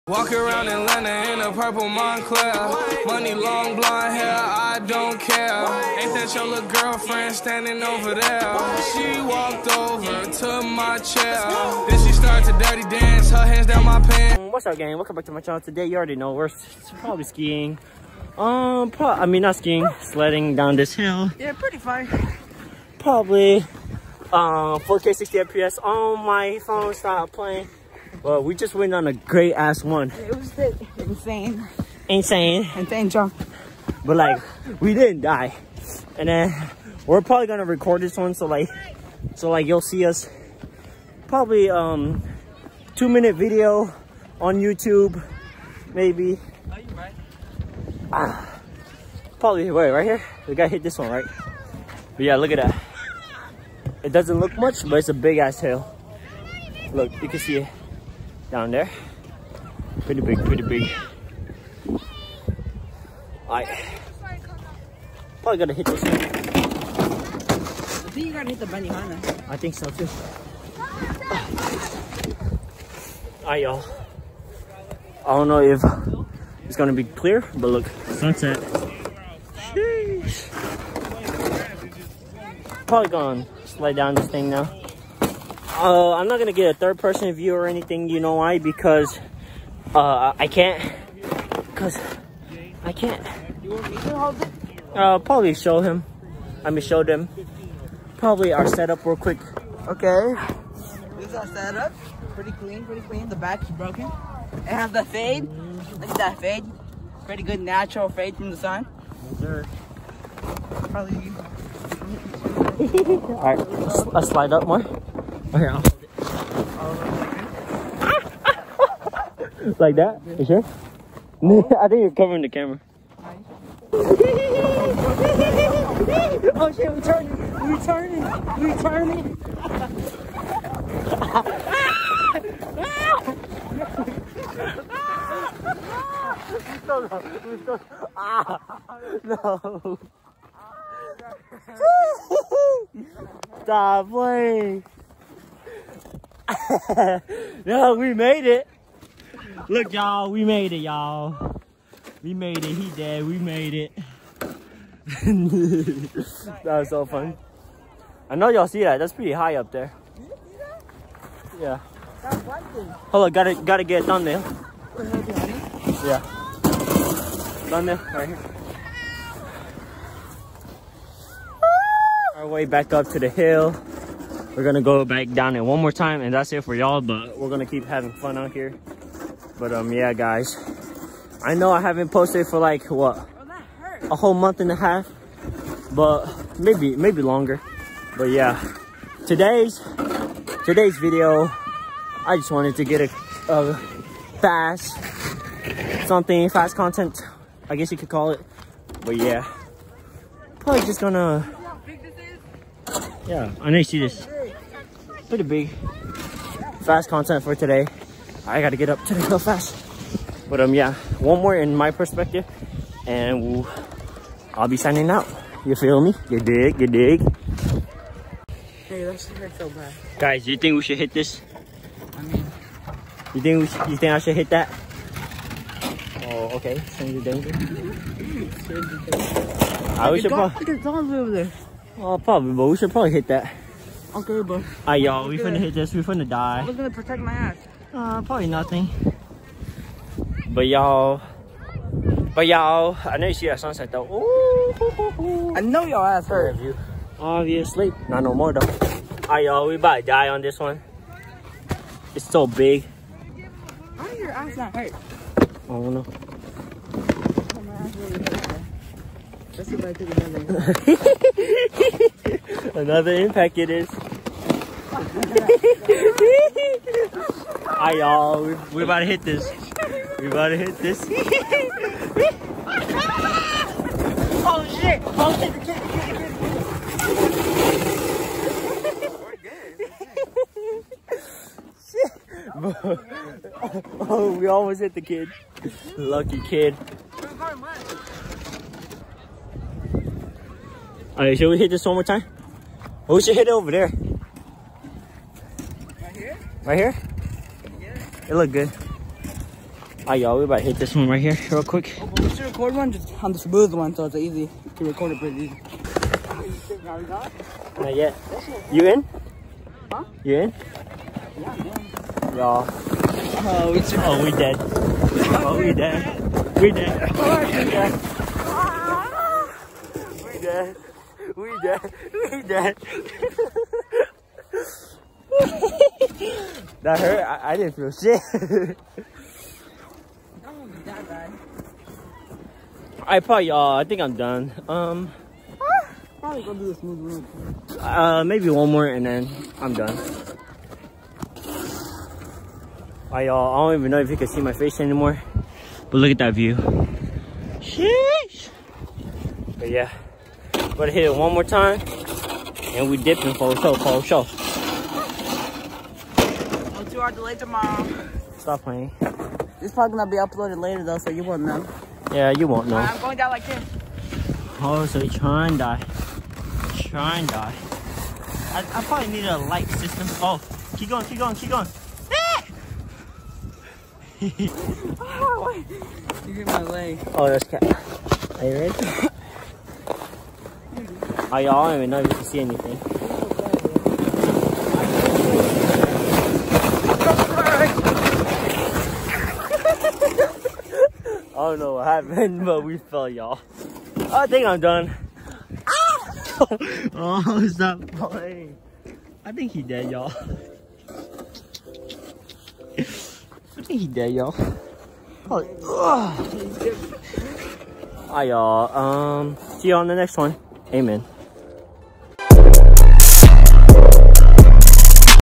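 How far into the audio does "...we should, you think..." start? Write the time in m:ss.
3:43.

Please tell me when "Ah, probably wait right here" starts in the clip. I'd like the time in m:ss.
0:48.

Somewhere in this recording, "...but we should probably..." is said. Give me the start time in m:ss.
3:52.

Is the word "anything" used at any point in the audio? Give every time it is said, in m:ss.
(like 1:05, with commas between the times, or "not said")
1:27, 6:22.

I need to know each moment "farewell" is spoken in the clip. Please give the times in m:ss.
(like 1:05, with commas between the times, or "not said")
not said.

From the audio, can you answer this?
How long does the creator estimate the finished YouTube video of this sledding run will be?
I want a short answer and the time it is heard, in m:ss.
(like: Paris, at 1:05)
2 minutes, at 0:42.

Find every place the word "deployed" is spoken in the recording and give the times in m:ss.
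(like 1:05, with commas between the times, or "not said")
not said.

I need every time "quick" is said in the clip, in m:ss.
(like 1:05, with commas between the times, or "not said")
1:39, 5:01.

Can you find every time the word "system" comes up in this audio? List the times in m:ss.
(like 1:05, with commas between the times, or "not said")
6:09.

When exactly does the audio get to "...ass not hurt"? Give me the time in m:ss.
4:14.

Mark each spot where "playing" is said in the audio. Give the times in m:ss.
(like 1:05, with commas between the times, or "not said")
0:27, 2:24, 5:58, 6:37.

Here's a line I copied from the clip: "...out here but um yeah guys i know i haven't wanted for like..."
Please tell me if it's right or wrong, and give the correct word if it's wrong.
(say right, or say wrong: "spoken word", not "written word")
wrong: "posted", not "wanted".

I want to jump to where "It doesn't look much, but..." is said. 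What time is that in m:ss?
0:54.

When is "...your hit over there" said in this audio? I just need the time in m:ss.
4:53.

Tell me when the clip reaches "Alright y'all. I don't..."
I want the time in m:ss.
1:13.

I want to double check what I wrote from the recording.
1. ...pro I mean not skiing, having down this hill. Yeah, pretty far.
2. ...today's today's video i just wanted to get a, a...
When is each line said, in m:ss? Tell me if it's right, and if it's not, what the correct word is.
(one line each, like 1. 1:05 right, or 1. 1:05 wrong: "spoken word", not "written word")
1. 0:18 wrong: "sledding", not "having"
2. 3:09 right.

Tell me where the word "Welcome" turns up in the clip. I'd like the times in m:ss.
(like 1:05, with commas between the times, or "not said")
0:14.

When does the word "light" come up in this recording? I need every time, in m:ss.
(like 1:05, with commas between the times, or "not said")
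6:09.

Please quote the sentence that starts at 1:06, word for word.
I think you gotta hit the banihana.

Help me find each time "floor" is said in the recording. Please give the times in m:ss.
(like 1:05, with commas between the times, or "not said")
not said.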